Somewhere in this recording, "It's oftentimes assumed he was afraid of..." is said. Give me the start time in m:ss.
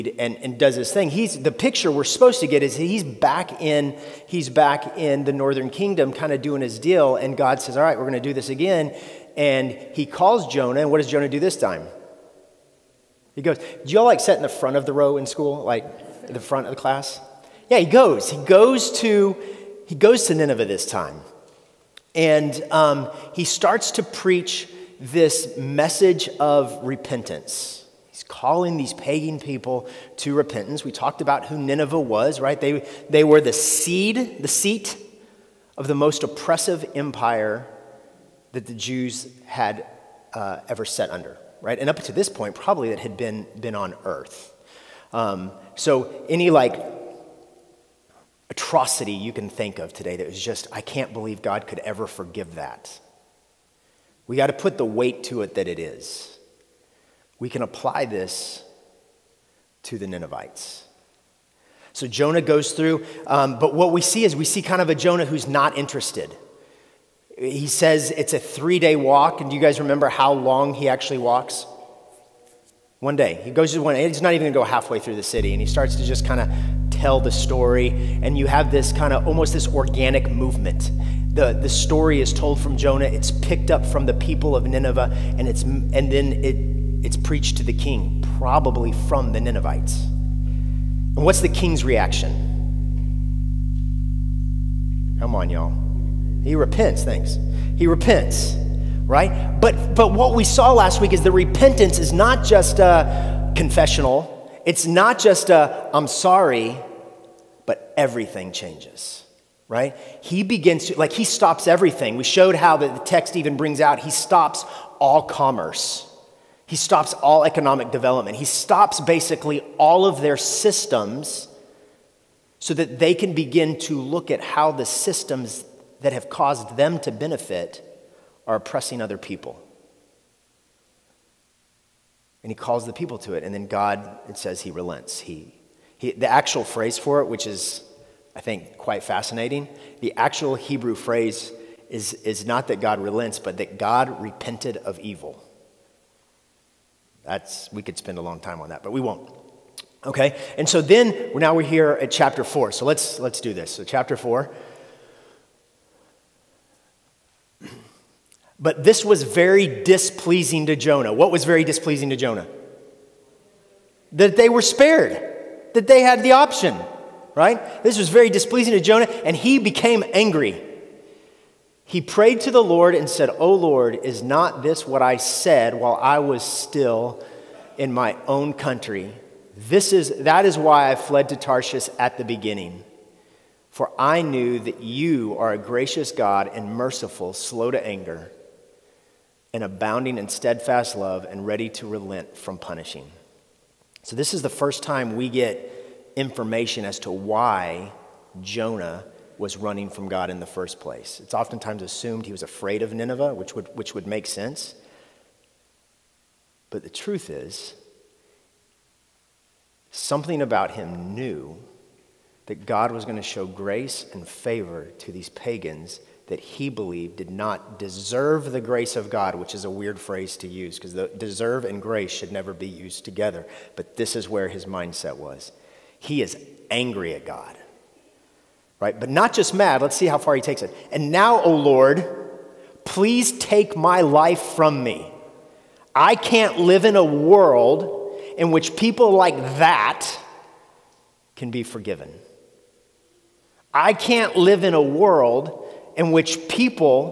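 3:21.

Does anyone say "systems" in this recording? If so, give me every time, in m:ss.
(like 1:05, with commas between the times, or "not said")
2:00, 2:04.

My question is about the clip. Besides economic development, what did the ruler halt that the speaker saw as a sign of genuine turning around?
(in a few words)
Commerce.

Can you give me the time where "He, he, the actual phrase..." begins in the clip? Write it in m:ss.
2:15.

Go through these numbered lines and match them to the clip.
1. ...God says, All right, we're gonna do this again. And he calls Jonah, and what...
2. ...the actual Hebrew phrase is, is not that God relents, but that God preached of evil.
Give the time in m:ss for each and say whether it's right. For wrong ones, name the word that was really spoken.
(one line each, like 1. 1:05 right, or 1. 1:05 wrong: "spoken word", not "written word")
1. 0:07 right
2. 2:20 wrong: "repented", not "preached".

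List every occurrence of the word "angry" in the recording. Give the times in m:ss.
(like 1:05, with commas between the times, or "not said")
2:50, 3:46.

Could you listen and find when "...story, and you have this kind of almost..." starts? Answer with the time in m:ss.
1:17.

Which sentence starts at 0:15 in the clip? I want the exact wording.
Like the front of the class?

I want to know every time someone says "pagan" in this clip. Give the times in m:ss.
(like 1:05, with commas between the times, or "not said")
0:28, 3:35.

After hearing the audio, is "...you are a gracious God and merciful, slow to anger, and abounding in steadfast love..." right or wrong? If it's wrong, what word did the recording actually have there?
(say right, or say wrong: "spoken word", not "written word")
right.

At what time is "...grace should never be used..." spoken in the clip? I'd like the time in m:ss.
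3:41.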